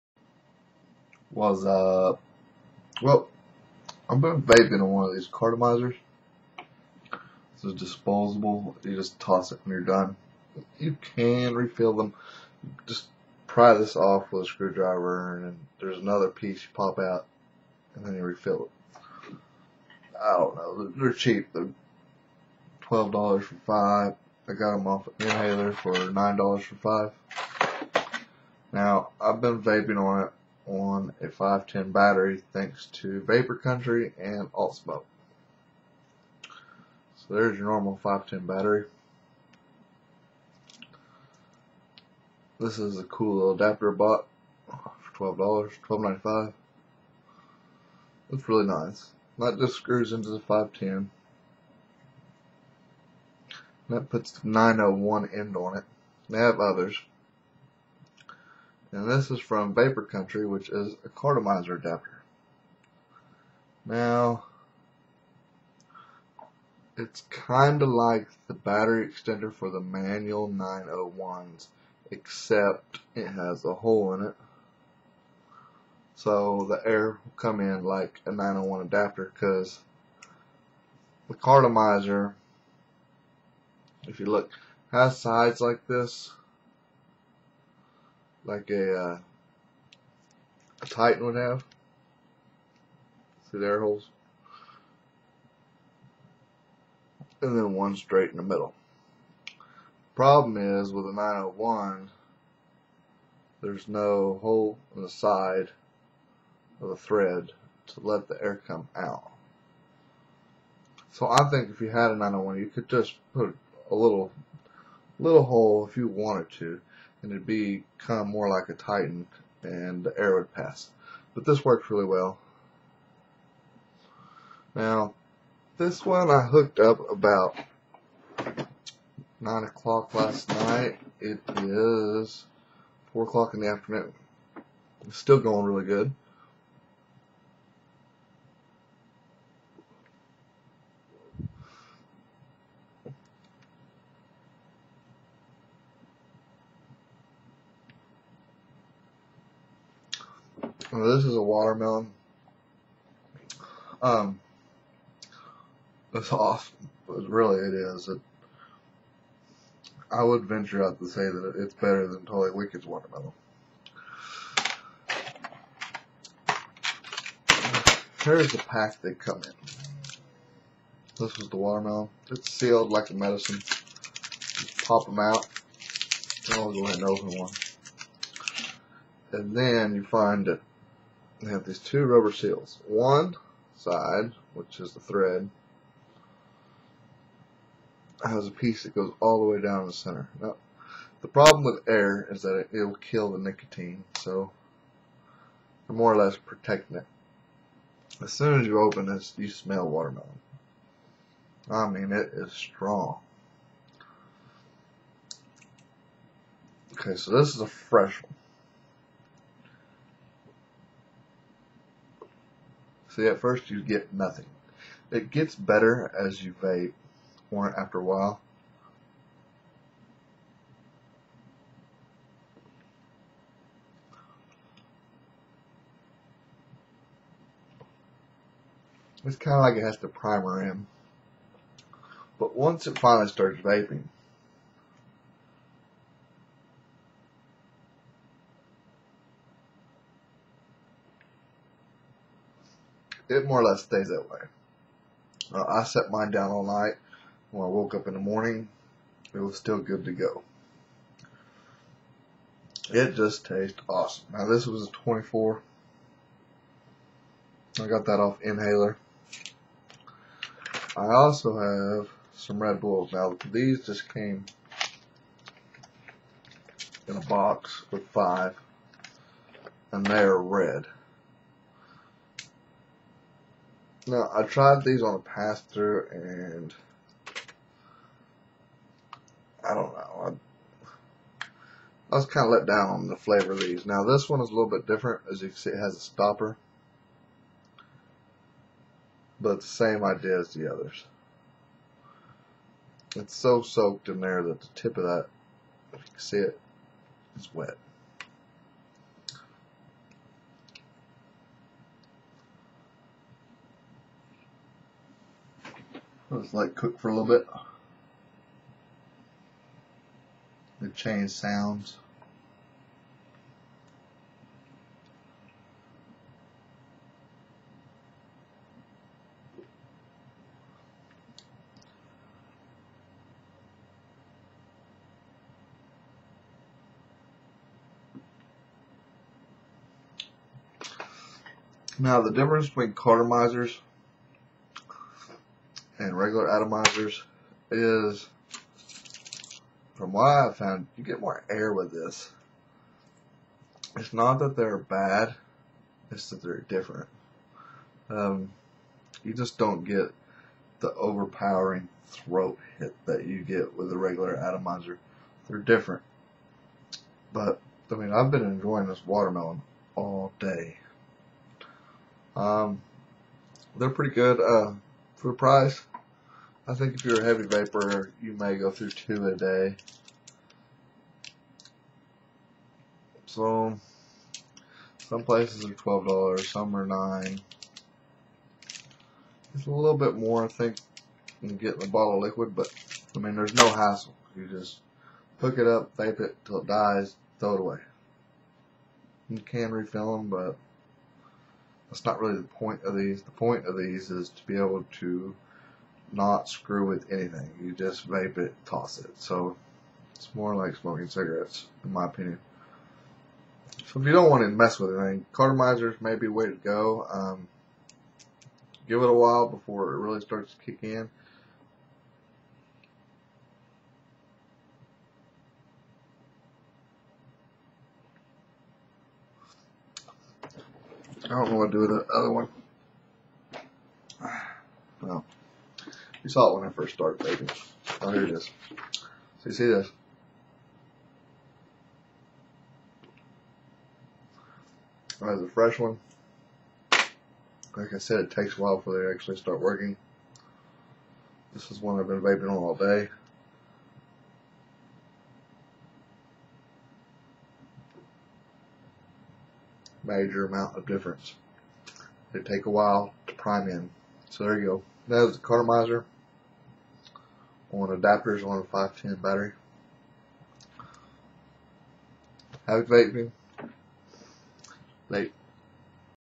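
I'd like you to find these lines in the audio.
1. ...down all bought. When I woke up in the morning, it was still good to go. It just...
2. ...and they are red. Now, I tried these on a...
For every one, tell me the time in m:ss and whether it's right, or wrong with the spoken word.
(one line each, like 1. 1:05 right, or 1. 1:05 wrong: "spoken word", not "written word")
1. 4:06 wrong: "night", not "bought"
2. 4:29 right.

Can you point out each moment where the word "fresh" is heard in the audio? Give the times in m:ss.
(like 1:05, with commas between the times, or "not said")
3:27, 7:15.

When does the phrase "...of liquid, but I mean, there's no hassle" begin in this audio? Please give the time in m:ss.
6:22.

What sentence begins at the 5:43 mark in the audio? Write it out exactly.
It's not that they're bad, it's that they're different.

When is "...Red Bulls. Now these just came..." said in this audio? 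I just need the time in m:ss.
4:22.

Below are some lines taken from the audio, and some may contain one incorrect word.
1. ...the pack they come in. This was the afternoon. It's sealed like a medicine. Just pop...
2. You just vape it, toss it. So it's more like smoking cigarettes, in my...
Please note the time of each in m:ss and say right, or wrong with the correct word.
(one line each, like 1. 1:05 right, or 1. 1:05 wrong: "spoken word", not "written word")
1. 2:48 wrong: "watermelon", not "afternoon"
2. 6:37 right.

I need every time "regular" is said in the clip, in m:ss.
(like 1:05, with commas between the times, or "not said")
5:36, 5:53.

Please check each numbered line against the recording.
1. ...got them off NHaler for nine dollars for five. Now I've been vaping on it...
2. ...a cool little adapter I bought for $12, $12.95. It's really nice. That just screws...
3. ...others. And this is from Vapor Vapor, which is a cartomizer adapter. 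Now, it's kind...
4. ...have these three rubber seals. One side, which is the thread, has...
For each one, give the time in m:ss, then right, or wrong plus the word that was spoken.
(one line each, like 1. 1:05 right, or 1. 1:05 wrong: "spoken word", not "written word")
1. 0:24 right
2. 0:42 right
3. 0:56 wrong: "Country", not "Vapor"
4. 3:01 wrong: "two", not "three".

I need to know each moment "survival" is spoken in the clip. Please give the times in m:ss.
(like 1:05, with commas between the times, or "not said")
not said.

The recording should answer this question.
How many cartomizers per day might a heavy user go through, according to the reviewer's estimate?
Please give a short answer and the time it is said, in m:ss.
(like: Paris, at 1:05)
2, at 6:08.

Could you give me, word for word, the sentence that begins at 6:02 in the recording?
Um, they're pretty good uh, for the price.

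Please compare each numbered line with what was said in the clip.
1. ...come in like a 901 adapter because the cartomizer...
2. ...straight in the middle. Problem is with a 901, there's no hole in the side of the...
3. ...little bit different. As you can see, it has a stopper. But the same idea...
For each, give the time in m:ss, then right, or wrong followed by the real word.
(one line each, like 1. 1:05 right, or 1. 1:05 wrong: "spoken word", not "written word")
1. 1:17 right
2. 1:37 right
3. 4:44 right.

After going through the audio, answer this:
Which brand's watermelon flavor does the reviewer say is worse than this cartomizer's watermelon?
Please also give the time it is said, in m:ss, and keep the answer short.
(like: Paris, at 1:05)
Totally Wicked, at 2:42.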